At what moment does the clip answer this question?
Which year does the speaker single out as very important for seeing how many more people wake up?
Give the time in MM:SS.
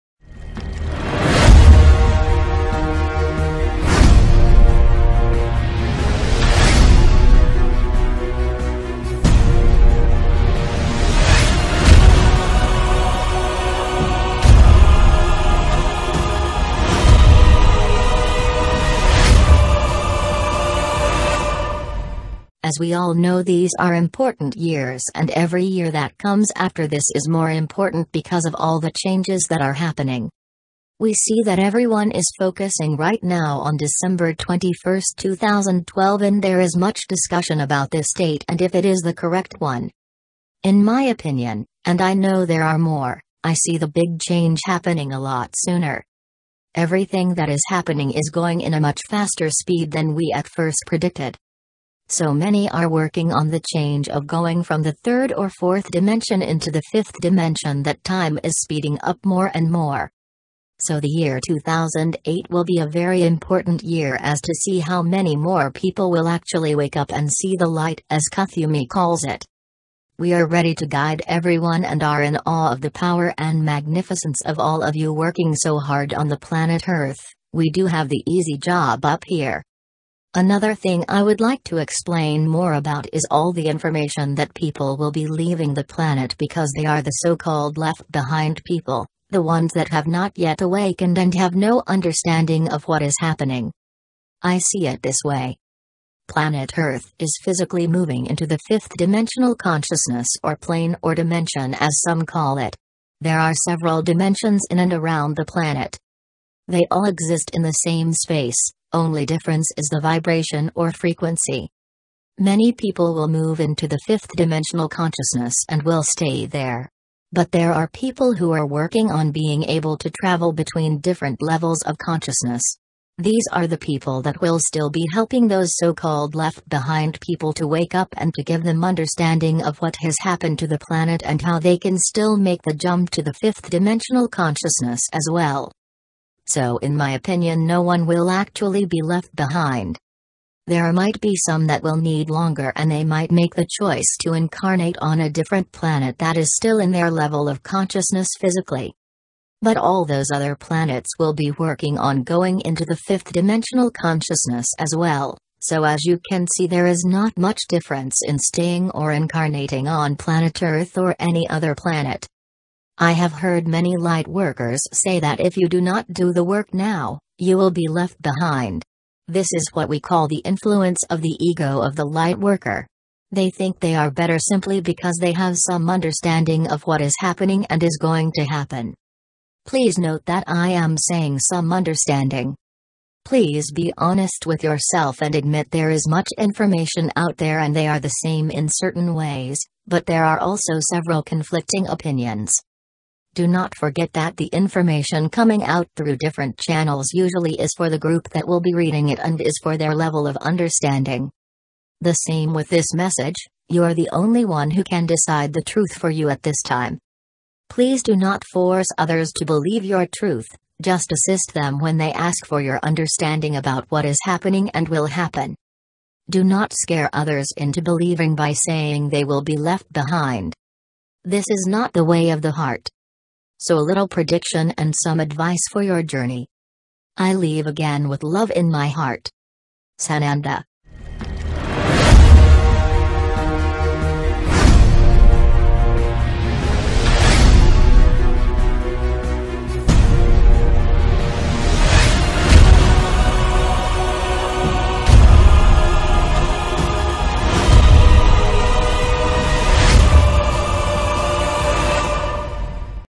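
01:01.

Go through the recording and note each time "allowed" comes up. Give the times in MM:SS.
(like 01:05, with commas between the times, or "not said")
not said.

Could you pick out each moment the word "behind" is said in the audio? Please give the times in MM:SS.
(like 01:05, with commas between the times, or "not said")
01:28, 02:06, 02:19, 02:48, 03:39.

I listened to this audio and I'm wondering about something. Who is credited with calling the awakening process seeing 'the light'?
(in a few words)
Kuthumi.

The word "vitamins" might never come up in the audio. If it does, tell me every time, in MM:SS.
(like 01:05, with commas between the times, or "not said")
not said.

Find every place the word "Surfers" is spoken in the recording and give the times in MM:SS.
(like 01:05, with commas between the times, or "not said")
not said.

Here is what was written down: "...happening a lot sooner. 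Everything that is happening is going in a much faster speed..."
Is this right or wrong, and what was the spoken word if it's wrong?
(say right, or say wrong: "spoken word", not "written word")
right.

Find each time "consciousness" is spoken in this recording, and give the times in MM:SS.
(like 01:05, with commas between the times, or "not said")
01:39, 01:54, 02:01, 02:14, 02:27, 02:33.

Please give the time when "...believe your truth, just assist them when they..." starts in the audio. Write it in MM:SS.
03:29.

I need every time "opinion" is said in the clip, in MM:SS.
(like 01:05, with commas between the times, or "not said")
00:41, 02:17, 03:11.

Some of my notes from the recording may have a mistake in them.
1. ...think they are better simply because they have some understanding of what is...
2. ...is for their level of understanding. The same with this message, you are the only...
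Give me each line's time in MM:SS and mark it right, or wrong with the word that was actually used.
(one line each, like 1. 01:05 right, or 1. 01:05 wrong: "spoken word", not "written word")
1. 02:53 right
2. 03:19 right.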